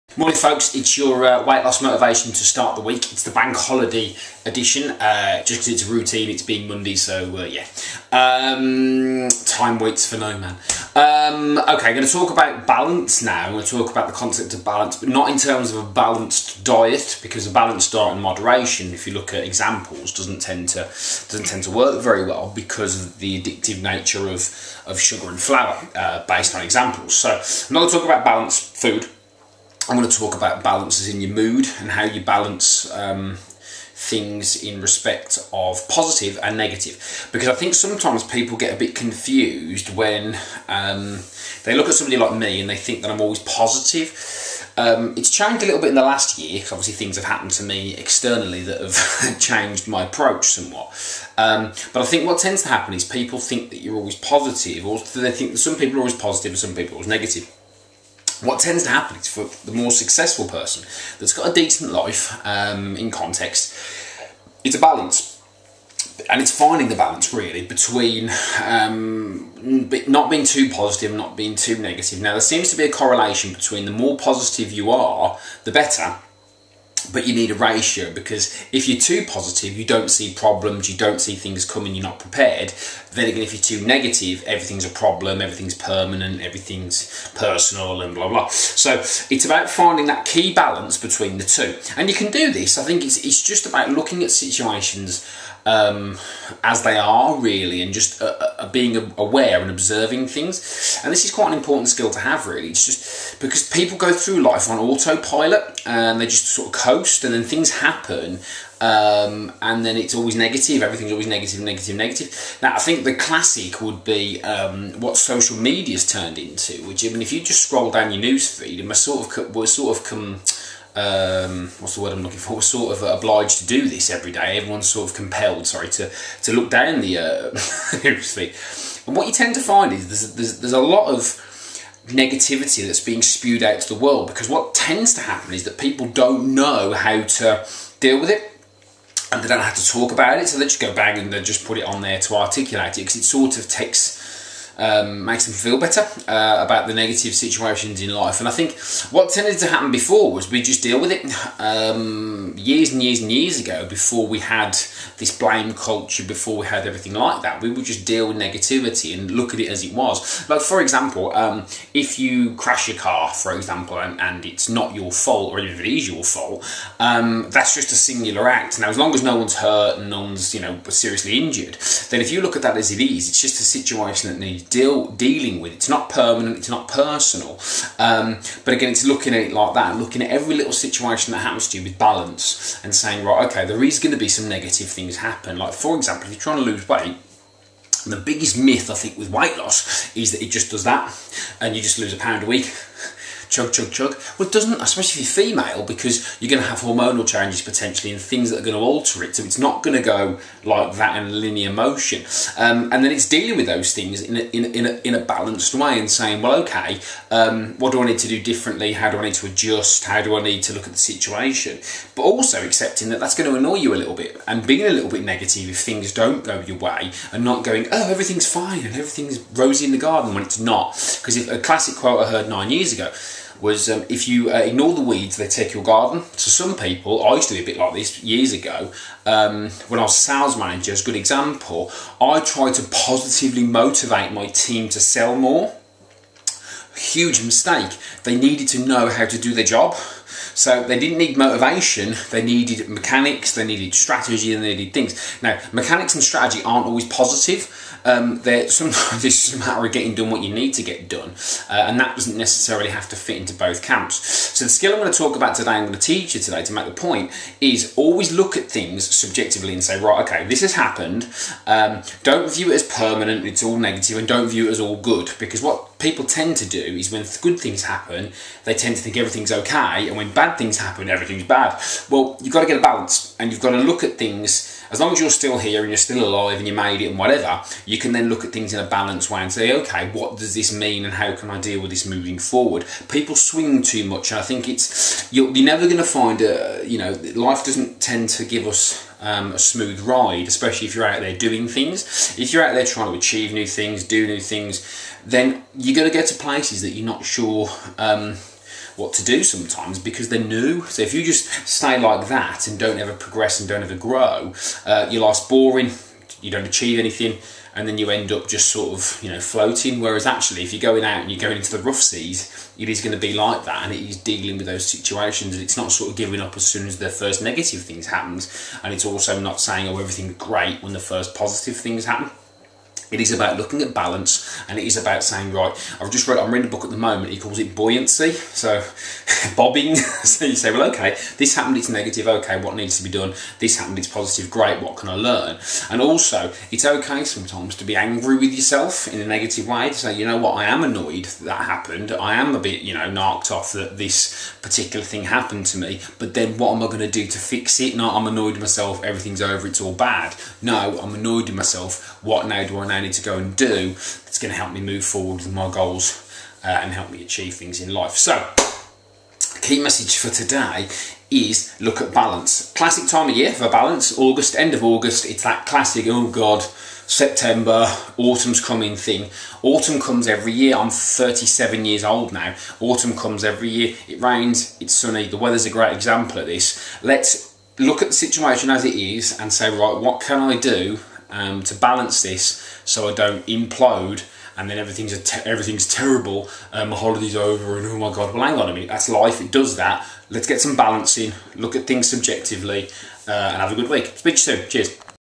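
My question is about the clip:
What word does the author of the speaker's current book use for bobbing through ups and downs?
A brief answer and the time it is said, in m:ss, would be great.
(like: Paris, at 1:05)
buoyancy, at 5:27.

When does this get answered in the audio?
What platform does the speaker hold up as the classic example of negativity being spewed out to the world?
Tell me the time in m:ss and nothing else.
1:55.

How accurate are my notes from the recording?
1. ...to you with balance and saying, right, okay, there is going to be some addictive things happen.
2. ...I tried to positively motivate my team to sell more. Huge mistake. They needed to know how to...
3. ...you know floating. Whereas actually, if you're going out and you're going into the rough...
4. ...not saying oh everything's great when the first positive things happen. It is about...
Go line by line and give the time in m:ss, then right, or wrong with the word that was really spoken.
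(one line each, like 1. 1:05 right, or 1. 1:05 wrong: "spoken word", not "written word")
1. 3:01 wrong: "negative", not "addictive"
2. 3:52 right
3. 5:09 right
4. 5:19 right.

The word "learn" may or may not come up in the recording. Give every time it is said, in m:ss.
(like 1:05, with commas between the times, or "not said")
5:35.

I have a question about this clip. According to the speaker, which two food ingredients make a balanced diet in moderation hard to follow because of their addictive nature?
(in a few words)
sugar and flour.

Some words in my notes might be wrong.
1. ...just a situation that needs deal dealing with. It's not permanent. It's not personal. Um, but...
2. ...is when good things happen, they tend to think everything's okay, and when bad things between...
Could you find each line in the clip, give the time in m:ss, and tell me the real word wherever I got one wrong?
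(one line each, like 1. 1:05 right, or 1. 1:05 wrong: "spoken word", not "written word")
1. 2:53 right
2. 4:26 wrong: "happen", not "between".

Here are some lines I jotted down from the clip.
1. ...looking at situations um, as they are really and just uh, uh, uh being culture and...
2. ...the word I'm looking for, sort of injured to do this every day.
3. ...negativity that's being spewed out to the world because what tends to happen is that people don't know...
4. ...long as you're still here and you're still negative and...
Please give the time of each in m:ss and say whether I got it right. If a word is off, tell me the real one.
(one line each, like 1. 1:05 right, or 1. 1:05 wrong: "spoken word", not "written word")
1. 1:33 wrong: "aware", not "culture"
2. 2:01 wrong: "obliged", not "injured"
3. 2:12 right
4. 4:34 wrong: "alive", not "negative".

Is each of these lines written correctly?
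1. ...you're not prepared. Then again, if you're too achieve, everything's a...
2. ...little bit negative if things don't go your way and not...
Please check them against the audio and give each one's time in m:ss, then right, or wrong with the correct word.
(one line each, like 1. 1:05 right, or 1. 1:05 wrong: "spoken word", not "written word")
1. 1:21 wrong: "negative", not "achieve"
2. 3:34 right.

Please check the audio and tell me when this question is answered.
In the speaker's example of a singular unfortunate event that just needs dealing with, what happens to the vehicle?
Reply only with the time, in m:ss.
2:42.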